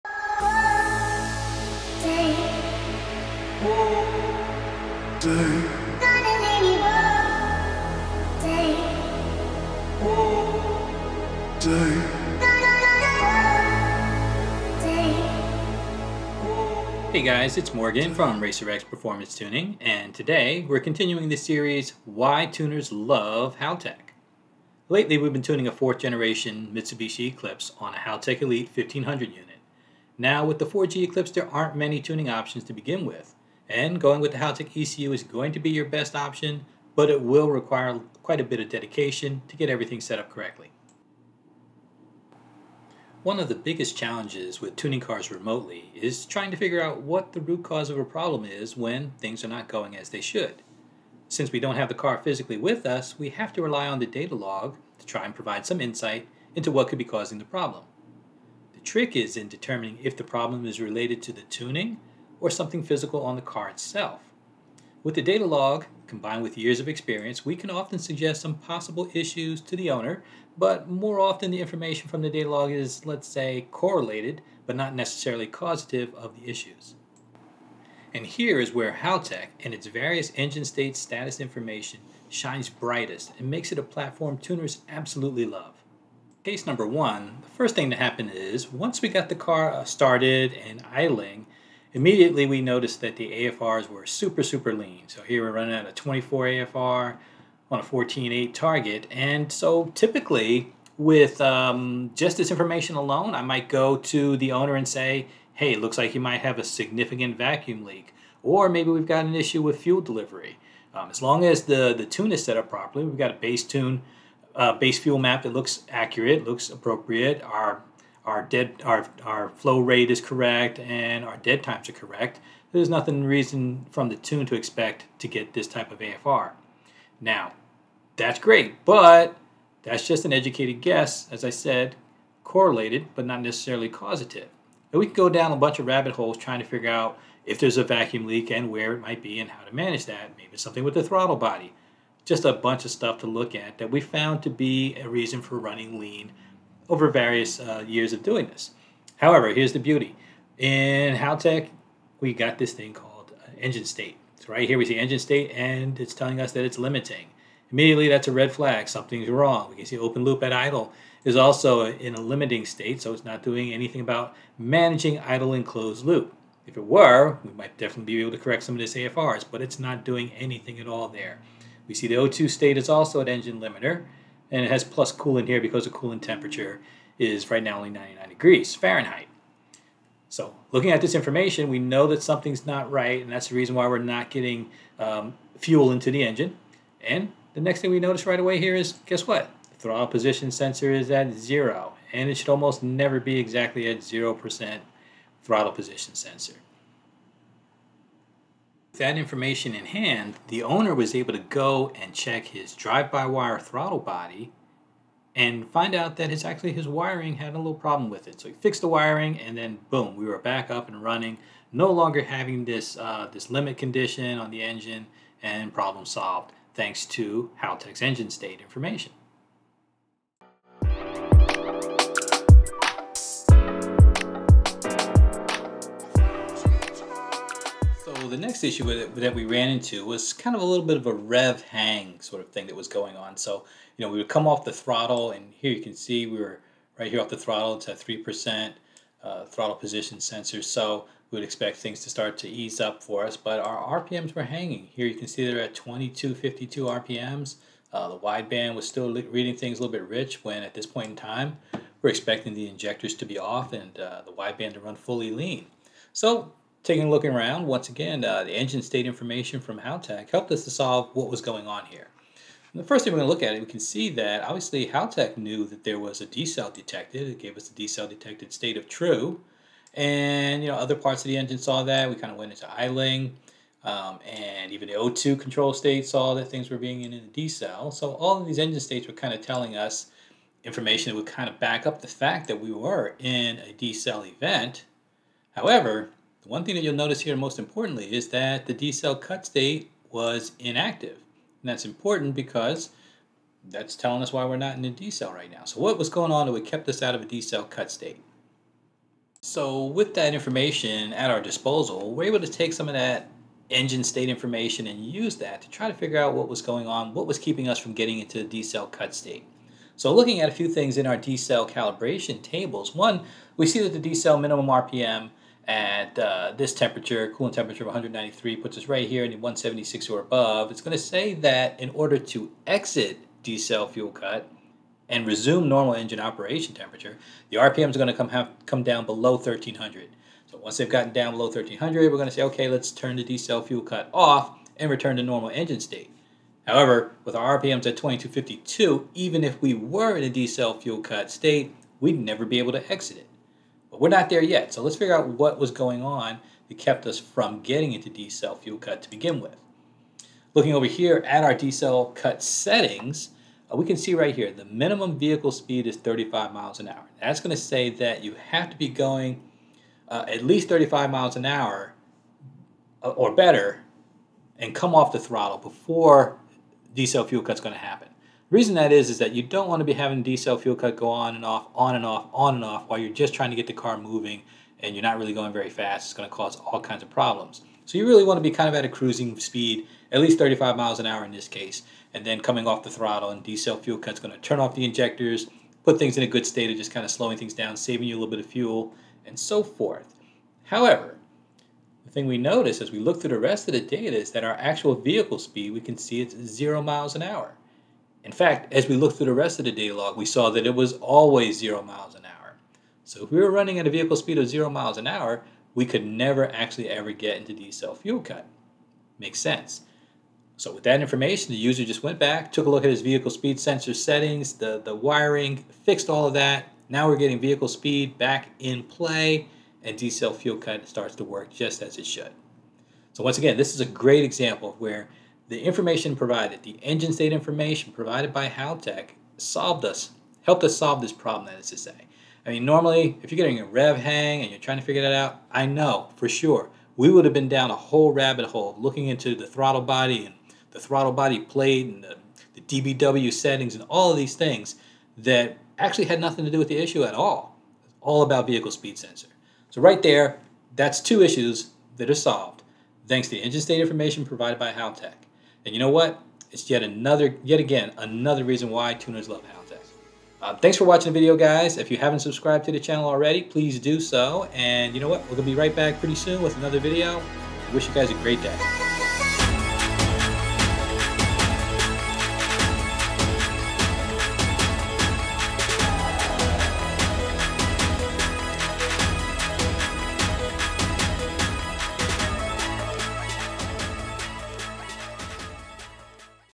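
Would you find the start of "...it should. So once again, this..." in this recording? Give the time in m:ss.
7:01.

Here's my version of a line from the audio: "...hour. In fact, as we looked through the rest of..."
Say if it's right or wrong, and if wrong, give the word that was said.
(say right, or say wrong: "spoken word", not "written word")
right.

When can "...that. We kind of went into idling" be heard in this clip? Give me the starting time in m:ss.
4:31.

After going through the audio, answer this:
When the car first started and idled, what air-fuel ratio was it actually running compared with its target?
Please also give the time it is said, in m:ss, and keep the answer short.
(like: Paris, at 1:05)
24, at 1:35.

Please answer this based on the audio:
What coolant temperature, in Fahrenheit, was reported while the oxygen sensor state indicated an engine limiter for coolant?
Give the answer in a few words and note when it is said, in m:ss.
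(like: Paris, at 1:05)
99 degrees Fahrenheit, at 2:57.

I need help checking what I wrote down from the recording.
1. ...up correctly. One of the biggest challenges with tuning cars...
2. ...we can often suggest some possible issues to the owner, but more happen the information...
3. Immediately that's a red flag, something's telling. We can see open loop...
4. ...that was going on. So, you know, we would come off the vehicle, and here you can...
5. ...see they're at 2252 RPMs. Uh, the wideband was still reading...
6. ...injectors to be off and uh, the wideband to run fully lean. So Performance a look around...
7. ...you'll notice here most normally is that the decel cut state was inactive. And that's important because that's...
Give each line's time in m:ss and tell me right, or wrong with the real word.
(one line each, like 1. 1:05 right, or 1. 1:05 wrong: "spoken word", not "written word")
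1. 0:40 right
2. 1:07 wrong: "often", not "happen"
3. 2:37 wrong: "wrong", not "telling"
4. 3:52 wrong: "throttle", not "vehicle"
5. 4:05 right
6. 4:12 wrong: "Taking", not "Performance"
7. 4:46 wrong: "importantly", not "normally".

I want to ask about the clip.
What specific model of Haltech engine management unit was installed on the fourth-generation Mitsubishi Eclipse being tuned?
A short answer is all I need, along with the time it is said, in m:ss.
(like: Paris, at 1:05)
Elite 1500, at 0:28.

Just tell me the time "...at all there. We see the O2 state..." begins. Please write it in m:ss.
2:50.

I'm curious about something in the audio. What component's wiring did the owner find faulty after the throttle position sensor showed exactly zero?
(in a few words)
drive-by-wire throttle body.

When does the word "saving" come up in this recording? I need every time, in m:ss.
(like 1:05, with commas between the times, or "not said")
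6:27.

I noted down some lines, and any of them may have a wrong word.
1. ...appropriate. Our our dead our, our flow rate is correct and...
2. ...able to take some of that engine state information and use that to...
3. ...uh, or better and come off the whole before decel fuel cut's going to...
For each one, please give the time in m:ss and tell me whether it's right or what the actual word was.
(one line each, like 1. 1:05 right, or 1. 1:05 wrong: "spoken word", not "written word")
1. 1:56 right
2. 5:02 right
3. 6:03 wrong: "throttle", not "whole".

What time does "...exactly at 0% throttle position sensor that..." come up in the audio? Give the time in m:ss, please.
3:13.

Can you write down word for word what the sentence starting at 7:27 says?
It's all about vehicle speed sensor.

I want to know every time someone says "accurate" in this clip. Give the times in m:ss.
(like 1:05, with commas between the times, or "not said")
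1:55.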